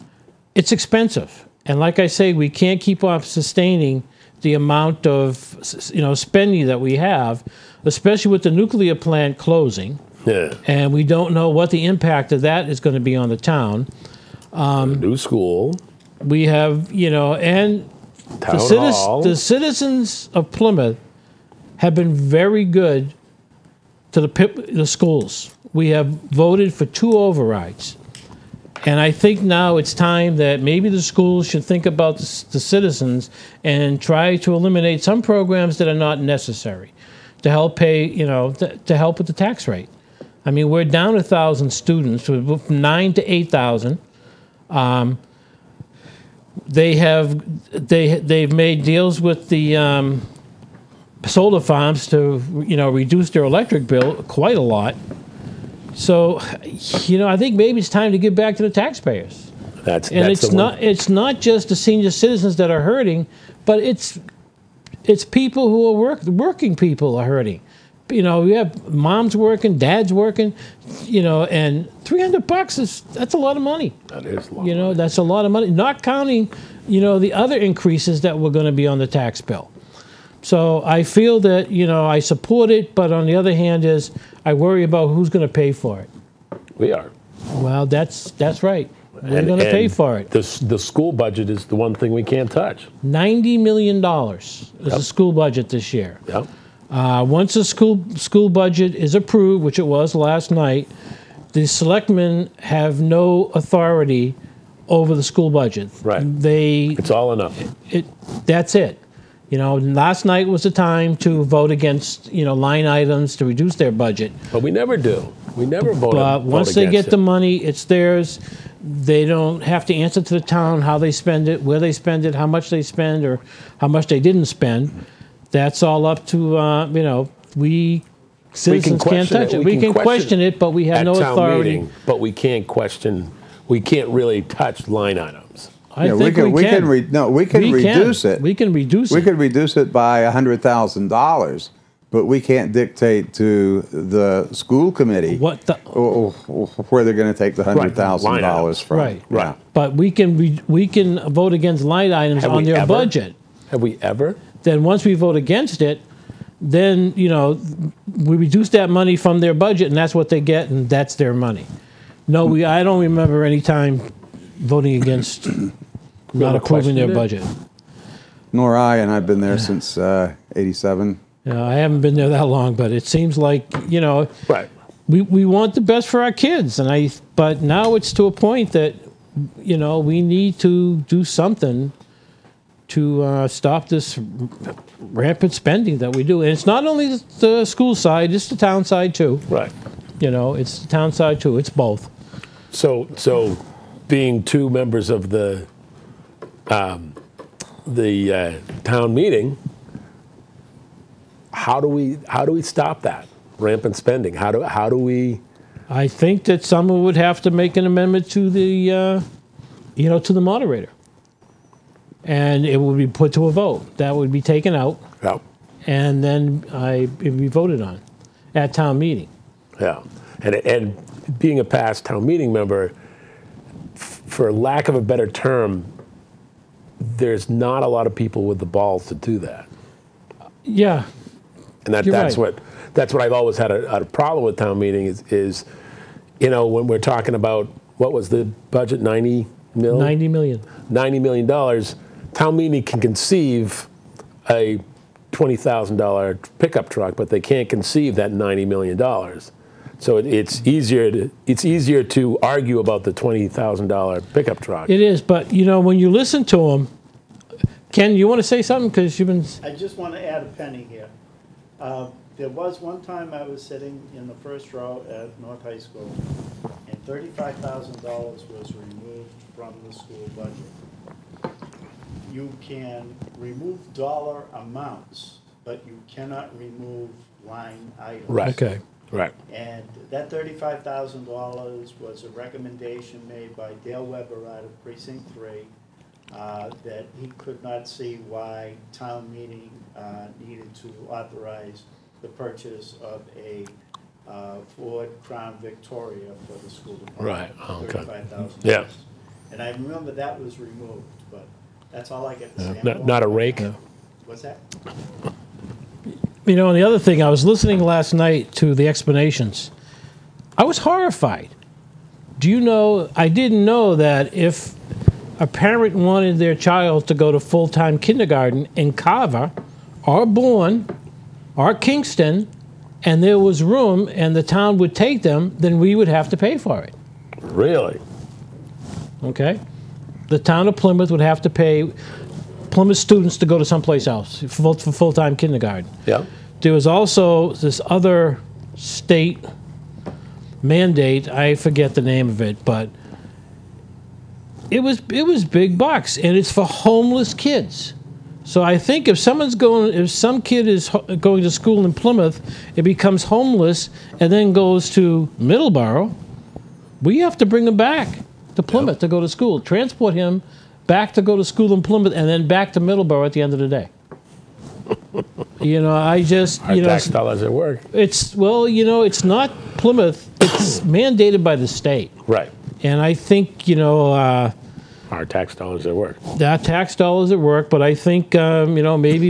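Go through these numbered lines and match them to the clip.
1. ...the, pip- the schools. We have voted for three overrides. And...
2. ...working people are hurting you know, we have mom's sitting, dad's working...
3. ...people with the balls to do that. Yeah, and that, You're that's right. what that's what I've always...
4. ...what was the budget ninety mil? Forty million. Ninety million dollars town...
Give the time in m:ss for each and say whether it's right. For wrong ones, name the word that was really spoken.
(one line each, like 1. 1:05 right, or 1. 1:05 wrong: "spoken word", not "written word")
1. 0:24 wrong: "two", not "three"
2. 1:06 wrong: "working", not "sitting"
3. 3:48 right
4. 3:57 wrong: "Ninety", not "Forty".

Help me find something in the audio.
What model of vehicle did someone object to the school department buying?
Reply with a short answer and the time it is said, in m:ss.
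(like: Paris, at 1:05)
Ford Crown Victoria, at 4:54.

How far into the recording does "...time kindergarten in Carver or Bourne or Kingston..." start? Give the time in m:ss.
5:17.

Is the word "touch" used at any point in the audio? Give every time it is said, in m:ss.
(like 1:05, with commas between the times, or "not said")
1:32, 2:09, 2:14.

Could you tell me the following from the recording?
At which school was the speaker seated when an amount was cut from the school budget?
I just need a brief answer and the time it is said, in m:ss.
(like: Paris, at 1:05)
North High School, at 4:25.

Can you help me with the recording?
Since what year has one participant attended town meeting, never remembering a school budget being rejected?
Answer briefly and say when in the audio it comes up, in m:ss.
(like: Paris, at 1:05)
1987, at 2:49.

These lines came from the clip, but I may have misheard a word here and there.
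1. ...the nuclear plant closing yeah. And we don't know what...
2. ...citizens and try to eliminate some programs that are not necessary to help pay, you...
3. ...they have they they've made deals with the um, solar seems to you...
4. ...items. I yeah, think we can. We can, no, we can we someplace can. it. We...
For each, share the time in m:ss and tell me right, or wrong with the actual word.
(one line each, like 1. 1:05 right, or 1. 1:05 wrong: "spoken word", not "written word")
1. 0:08 right
2. 0:32 right
3. 0:46 wrong: "farms", not "seems"
4. 2:15 wrong: "reduce", not "someplace".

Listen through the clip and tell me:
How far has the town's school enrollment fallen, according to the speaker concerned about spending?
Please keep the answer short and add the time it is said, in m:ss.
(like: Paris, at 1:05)
1,000 students, at 0:41.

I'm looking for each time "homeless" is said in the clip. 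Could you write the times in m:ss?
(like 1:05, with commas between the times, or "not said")
5:46, 5:53.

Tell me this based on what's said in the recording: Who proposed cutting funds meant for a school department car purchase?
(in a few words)
Dale Weber.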